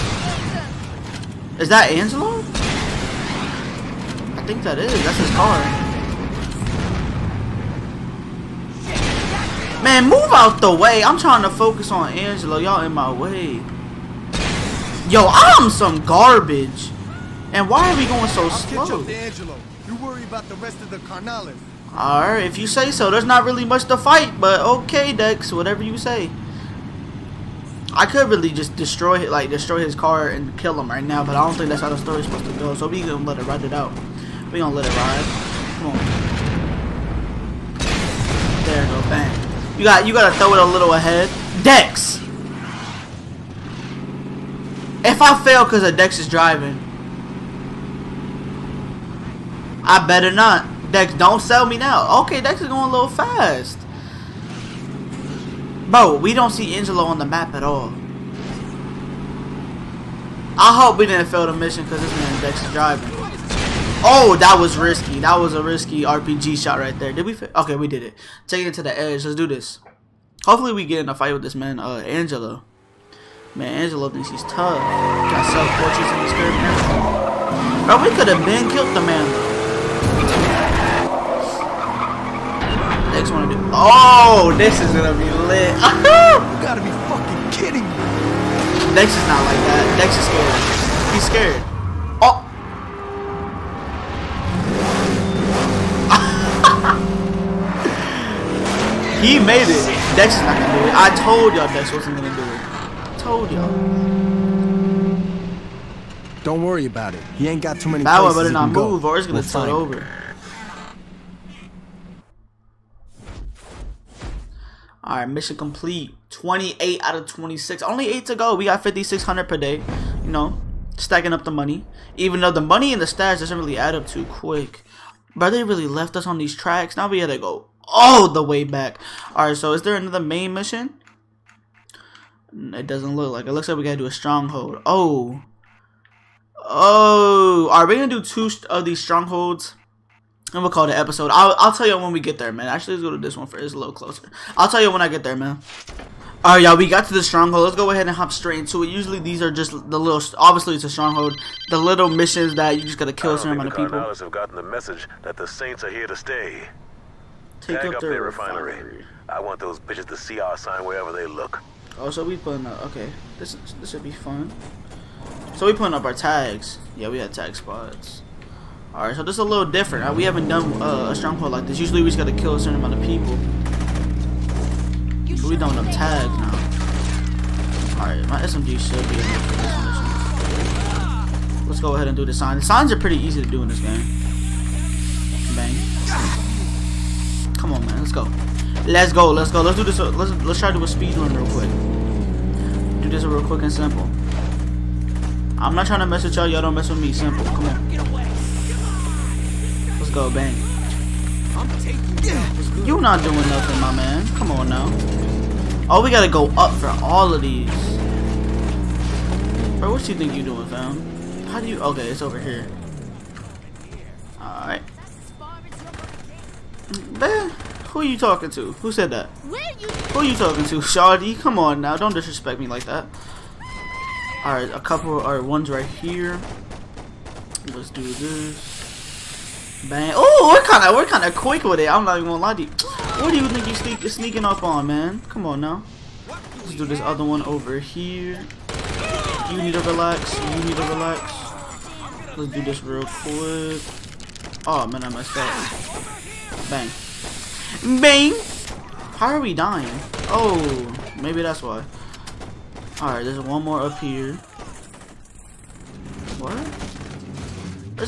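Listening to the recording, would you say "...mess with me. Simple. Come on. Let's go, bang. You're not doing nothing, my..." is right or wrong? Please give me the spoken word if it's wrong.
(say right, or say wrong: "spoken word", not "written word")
right.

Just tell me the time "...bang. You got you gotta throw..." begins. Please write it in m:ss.
0:39.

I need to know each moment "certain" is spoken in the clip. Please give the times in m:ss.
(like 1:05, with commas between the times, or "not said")
2:33, 2:52.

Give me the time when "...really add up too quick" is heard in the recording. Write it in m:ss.
2:03.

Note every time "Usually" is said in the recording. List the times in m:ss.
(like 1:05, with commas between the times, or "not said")
2:28, 2:51.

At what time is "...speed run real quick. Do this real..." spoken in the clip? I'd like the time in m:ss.
3:10.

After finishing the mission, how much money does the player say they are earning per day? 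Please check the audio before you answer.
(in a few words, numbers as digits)
5,600.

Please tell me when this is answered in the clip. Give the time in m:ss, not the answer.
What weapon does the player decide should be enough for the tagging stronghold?
2:58.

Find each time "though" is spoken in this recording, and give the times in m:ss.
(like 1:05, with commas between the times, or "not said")
1:19, 2:02.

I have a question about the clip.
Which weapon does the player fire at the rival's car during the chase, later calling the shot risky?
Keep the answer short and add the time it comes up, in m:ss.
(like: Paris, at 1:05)
RPG, at 1:06.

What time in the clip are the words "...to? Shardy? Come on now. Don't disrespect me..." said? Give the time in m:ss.
3:40.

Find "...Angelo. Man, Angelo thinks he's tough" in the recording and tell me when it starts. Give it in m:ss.
1:12.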